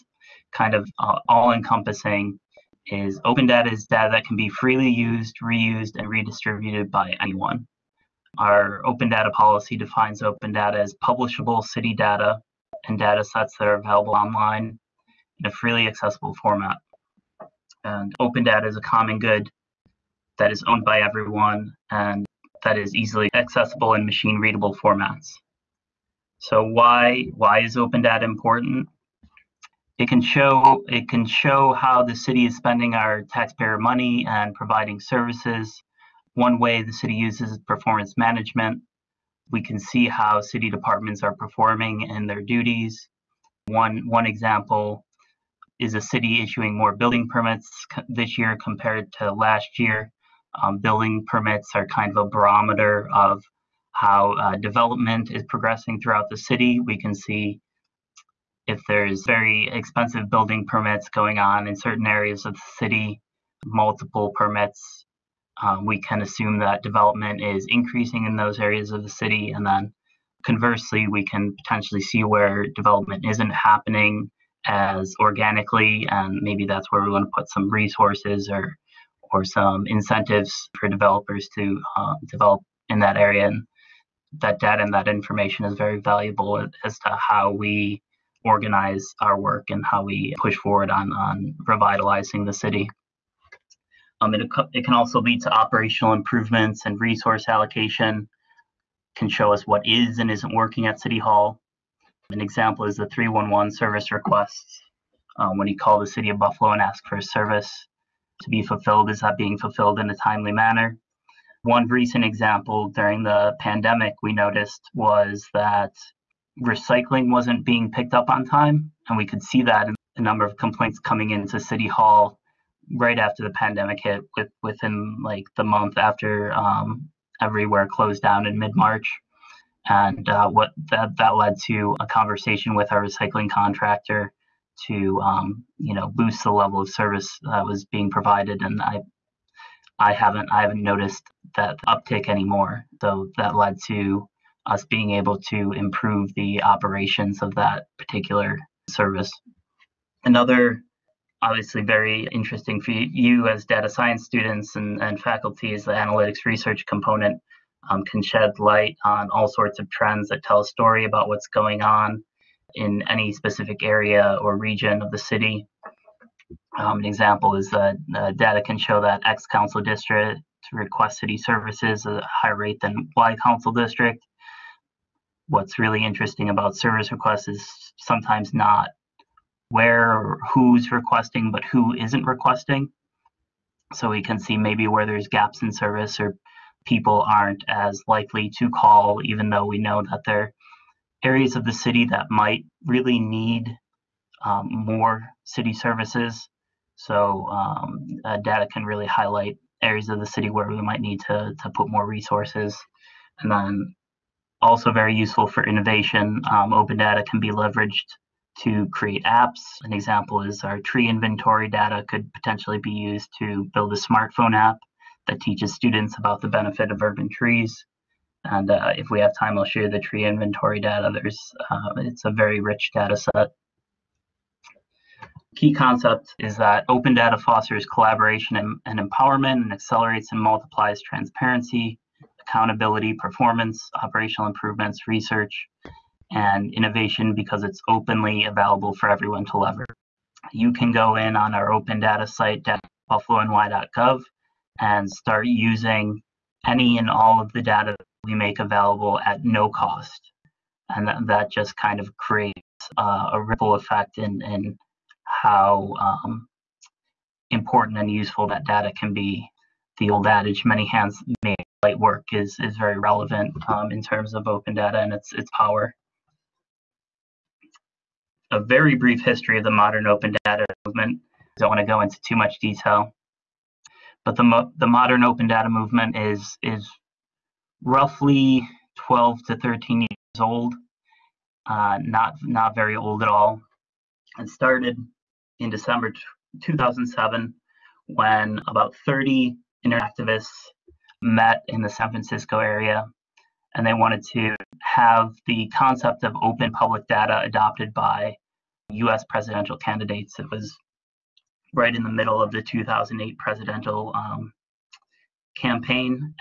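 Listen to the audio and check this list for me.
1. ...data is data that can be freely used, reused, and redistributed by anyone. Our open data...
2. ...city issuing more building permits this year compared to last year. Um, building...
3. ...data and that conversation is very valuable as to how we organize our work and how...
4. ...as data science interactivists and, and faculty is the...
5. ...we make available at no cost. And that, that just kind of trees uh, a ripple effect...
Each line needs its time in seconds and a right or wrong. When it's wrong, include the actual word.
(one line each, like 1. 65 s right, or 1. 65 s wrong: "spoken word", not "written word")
1. 3 s right
2. 46 s right
3. 84 s wrong: "information", not "conversation"
4. 153 s wrong: "students", not "interactivists"
5. 248 s wrong: "creates", not "trees".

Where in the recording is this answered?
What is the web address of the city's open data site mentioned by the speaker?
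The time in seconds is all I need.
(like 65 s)
243 s.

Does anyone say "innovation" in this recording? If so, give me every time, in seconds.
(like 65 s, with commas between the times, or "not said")
205 s, 236 s.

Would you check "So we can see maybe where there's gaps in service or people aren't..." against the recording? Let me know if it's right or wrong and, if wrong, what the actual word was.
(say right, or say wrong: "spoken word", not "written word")
right.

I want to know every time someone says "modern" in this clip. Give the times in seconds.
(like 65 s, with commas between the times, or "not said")
269 s, 274 s.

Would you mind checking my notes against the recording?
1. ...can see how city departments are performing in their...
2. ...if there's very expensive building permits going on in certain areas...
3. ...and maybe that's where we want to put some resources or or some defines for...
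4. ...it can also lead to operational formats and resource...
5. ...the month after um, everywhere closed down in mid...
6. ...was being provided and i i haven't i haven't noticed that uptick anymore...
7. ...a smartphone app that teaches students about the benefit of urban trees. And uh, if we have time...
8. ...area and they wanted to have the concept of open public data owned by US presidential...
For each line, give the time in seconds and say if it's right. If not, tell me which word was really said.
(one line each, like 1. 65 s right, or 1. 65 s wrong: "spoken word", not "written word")
1. 39 s right
2. 58 s right
3. 76 s wrong: "incentives", not "defines"
4. 94 s wrong: "improvements", not "formats"
5. 125 s right
6. 137 s right
7. 213 s right
8. 292 s wrong: "adopted", not "owned".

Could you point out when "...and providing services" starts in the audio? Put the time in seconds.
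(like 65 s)
34 s.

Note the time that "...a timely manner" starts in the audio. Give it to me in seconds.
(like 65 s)
110 s.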